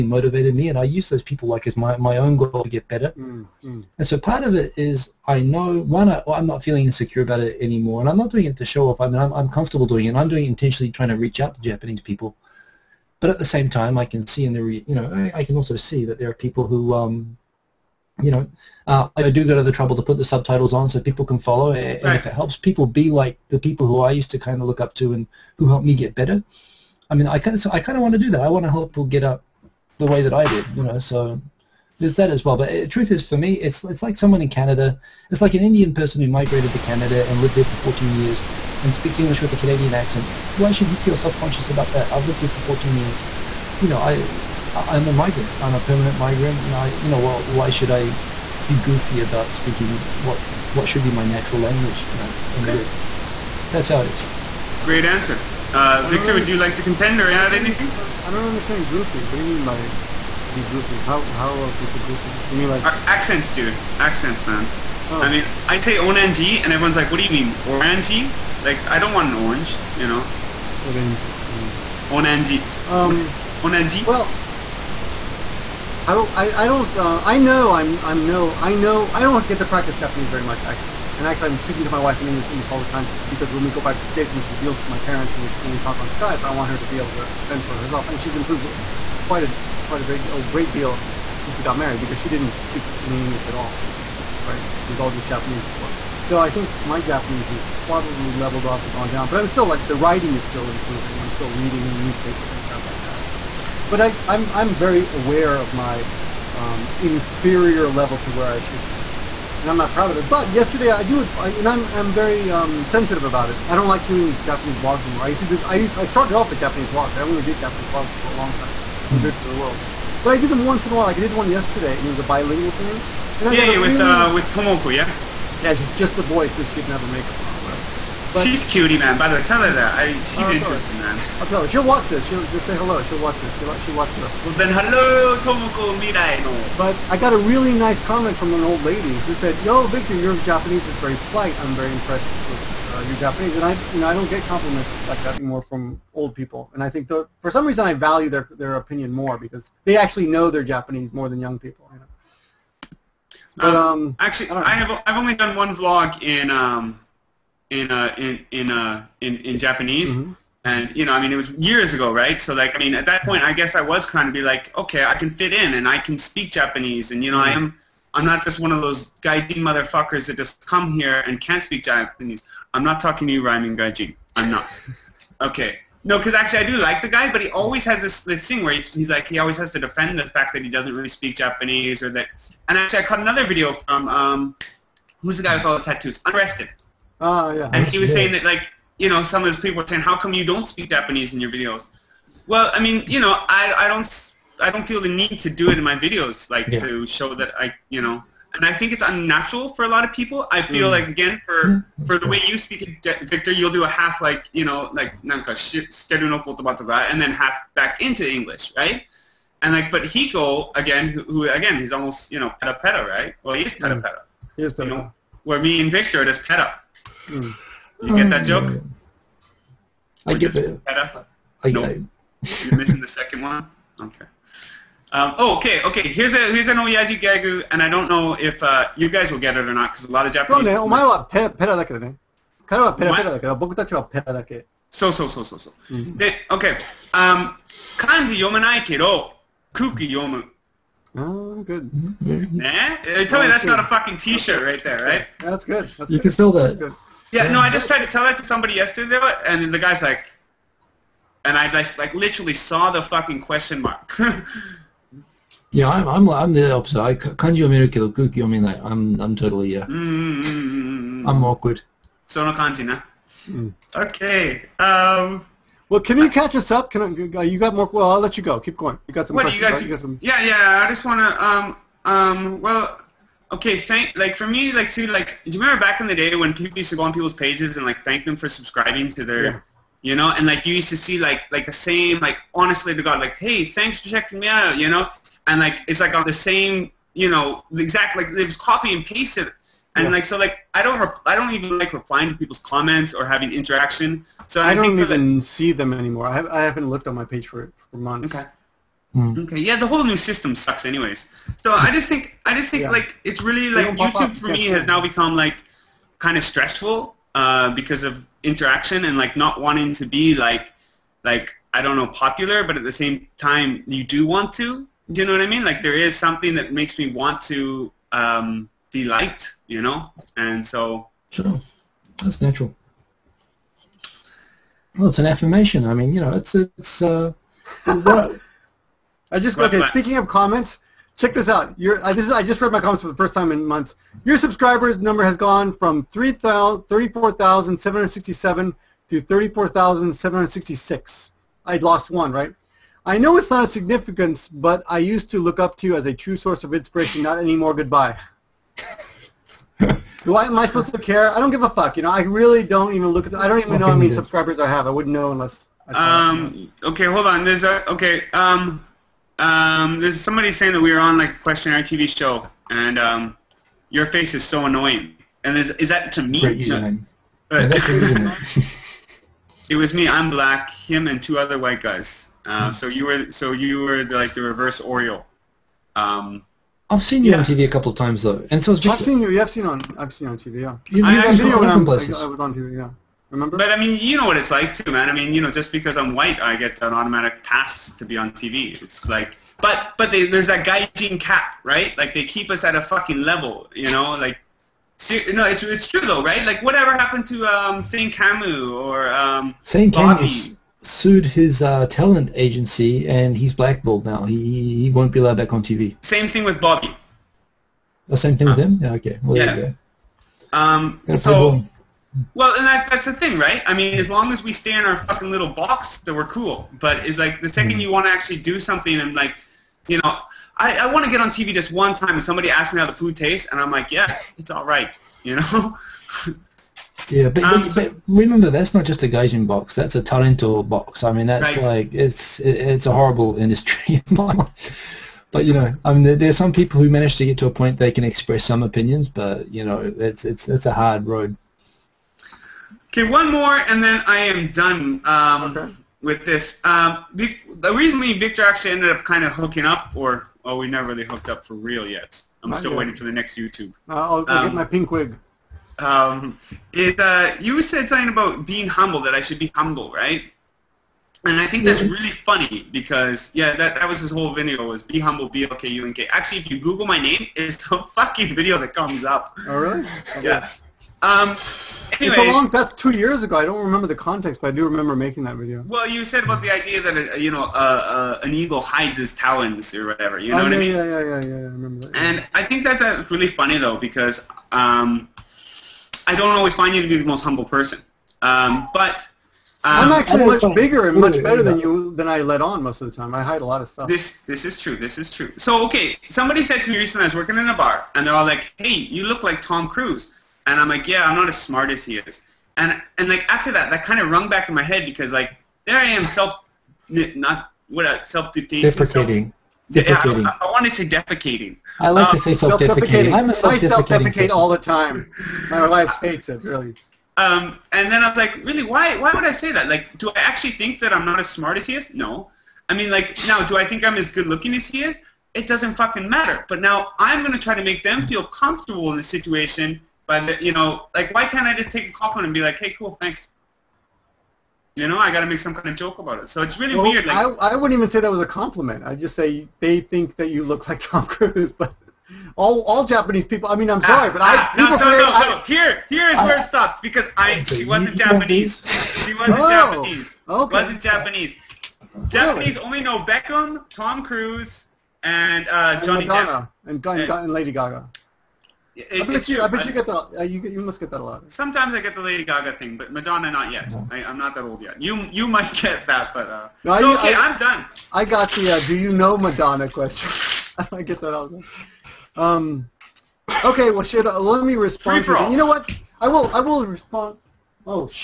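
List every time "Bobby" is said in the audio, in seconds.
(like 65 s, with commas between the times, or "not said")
399 s, 406 s.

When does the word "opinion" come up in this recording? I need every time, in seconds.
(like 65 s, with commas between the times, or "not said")
148 s, 438 s.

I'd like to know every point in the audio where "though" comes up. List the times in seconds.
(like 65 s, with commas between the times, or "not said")
378 s, 396 s, 483 s.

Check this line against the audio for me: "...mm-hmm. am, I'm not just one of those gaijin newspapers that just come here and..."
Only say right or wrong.
wrong.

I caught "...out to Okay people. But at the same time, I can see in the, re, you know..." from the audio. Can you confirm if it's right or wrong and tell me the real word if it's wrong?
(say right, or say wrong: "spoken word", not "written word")
wrong: "Japanese", not "Okay".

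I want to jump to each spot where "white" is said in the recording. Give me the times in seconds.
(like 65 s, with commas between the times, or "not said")
371 s, 386 s.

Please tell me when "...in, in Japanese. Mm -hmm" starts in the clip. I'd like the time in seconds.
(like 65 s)
159 s.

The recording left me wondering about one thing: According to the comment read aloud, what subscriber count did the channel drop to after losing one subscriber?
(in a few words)
34,766.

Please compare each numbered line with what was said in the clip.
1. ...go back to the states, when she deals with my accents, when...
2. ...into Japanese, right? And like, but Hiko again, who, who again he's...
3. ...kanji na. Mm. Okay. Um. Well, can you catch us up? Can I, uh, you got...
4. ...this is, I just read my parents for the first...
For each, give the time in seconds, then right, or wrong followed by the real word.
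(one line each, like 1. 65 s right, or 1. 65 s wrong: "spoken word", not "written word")
1. 83 s wrong: "parents", not "accents"
2. 207 s wrong: "English", not "Japanese"
3. 262 s right
4. 332 s wrong: "comments", not "parents".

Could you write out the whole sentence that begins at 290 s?
like so, like I don't rep- I don't even like replying to people's comments or having interaction.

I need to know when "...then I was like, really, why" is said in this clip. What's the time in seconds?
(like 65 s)
517 s.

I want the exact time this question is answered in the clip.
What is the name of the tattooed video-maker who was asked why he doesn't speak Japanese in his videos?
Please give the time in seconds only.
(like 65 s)
186 s.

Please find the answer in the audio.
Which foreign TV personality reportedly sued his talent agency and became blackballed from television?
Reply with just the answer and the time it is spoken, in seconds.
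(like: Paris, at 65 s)
Thane Camus, at 397 s.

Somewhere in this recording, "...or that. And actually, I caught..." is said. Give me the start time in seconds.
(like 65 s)
182 s.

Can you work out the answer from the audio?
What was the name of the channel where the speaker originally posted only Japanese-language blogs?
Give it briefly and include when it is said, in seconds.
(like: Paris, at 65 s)
Victor of the World, at 119 s.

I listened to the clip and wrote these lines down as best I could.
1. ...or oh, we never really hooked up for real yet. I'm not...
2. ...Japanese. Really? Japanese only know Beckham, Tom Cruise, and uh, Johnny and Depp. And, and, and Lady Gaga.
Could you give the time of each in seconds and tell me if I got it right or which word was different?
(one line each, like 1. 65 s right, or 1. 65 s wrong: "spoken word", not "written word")
1. 449 s right
2. 550 s right.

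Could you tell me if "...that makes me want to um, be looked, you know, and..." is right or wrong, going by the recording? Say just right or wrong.
wrong.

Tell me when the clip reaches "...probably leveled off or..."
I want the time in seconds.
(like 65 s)
97 s.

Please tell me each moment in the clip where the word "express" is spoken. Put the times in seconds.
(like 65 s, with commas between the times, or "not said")
438 s.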